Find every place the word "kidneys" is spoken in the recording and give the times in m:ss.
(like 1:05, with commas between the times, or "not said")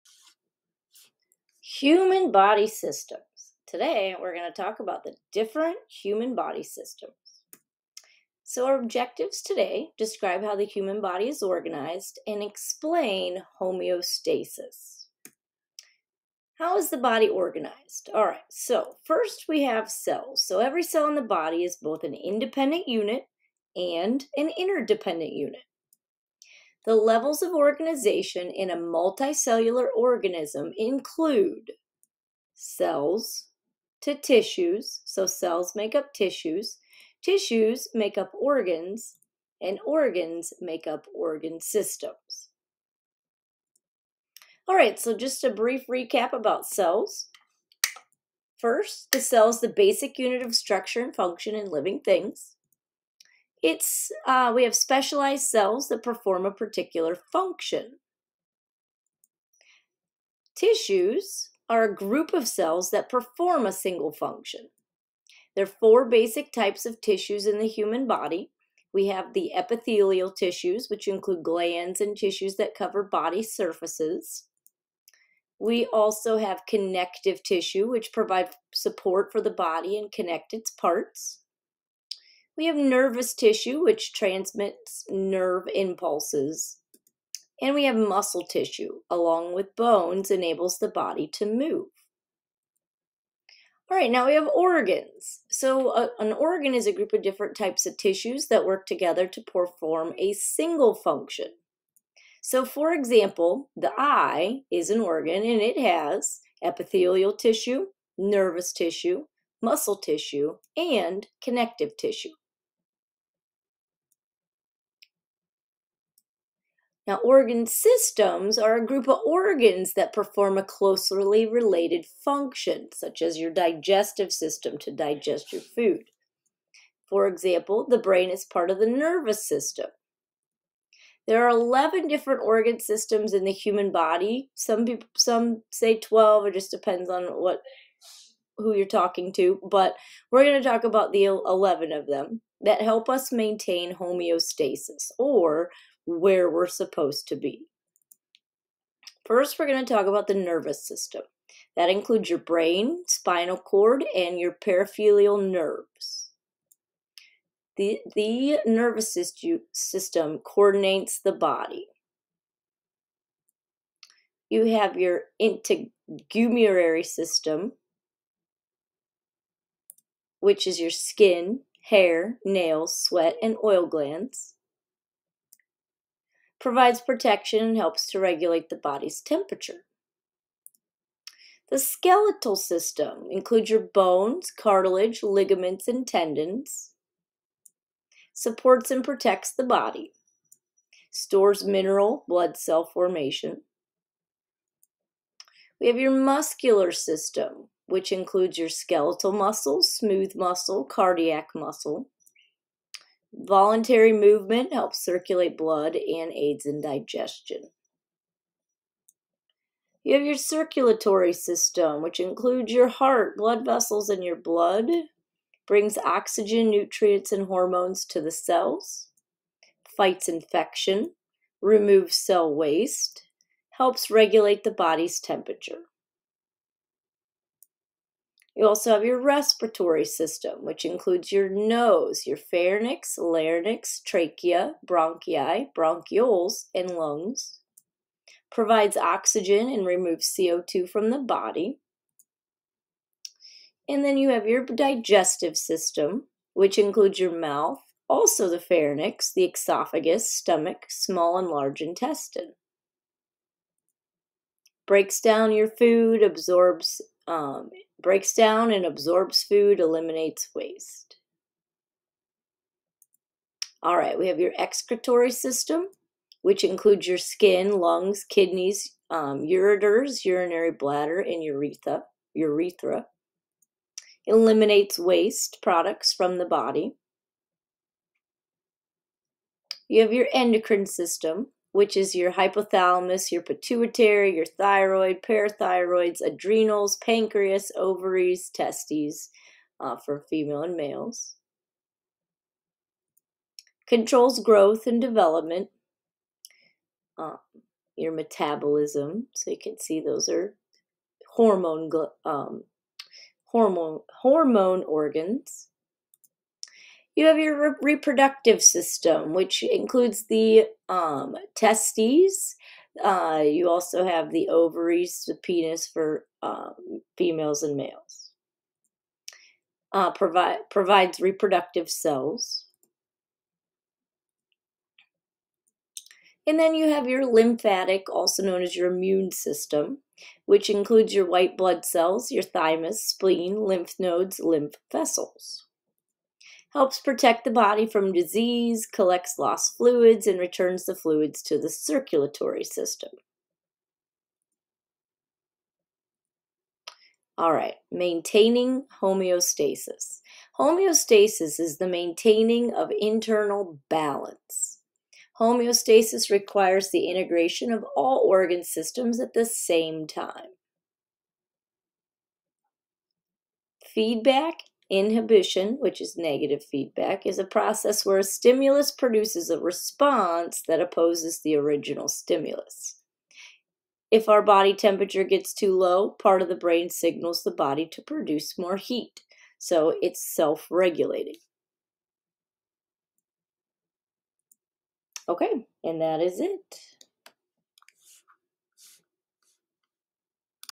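4:28.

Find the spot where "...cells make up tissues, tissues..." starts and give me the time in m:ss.
0:35.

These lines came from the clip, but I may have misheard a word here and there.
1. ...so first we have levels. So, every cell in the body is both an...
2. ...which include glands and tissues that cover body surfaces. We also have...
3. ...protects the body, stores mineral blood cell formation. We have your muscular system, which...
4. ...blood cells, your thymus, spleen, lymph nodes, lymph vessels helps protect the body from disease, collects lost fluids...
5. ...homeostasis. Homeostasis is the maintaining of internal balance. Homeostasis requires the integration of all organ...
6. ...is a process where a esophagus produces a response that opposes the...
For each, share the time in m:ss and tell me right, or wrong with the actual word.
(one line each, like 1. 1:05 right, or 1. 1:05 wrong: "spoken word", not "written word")
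1. 0:18 wrong: "cells", not "levels"
2. 1:10 right
3. 3:09 right
4. 5:31 right
5. 5:49 right
6. 6:07 wrong: "stimulus", not "esophagus".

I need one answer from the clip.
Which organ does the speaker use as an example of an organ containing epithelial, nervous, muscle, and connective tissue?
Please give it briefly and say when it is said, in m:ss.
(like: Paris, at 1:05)
the eye, at 1:43.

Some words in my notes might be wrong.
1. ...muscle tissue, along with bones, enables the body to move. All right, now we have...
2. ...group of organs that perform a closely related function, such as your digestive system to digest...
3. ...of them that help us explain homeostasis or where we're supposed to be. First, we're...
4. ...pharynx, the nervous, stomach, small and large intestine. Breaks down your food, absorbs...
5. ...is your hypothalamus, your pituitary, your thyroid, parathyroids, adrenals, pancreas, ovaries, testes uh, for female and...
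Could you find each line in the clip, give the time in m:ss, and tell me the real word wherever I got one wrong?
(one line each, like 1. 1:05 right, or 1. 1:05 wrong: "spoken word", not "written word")
1. 1:27 right
2. 1:58 right
3. 2:21 wrong: "maintain", not "explain"
4. 4:08 wrong: "esophagus", not "nervous"
5. 4:41 right.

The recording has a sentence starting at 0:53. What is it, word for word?
It's uh, we have specialized cells that perform a particular function.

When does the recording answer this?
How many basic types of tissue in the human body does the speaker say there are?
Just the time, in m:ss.
1:05.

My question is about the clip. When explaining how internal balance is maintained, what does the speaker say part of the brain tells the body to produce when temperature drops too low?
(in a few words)
more heat.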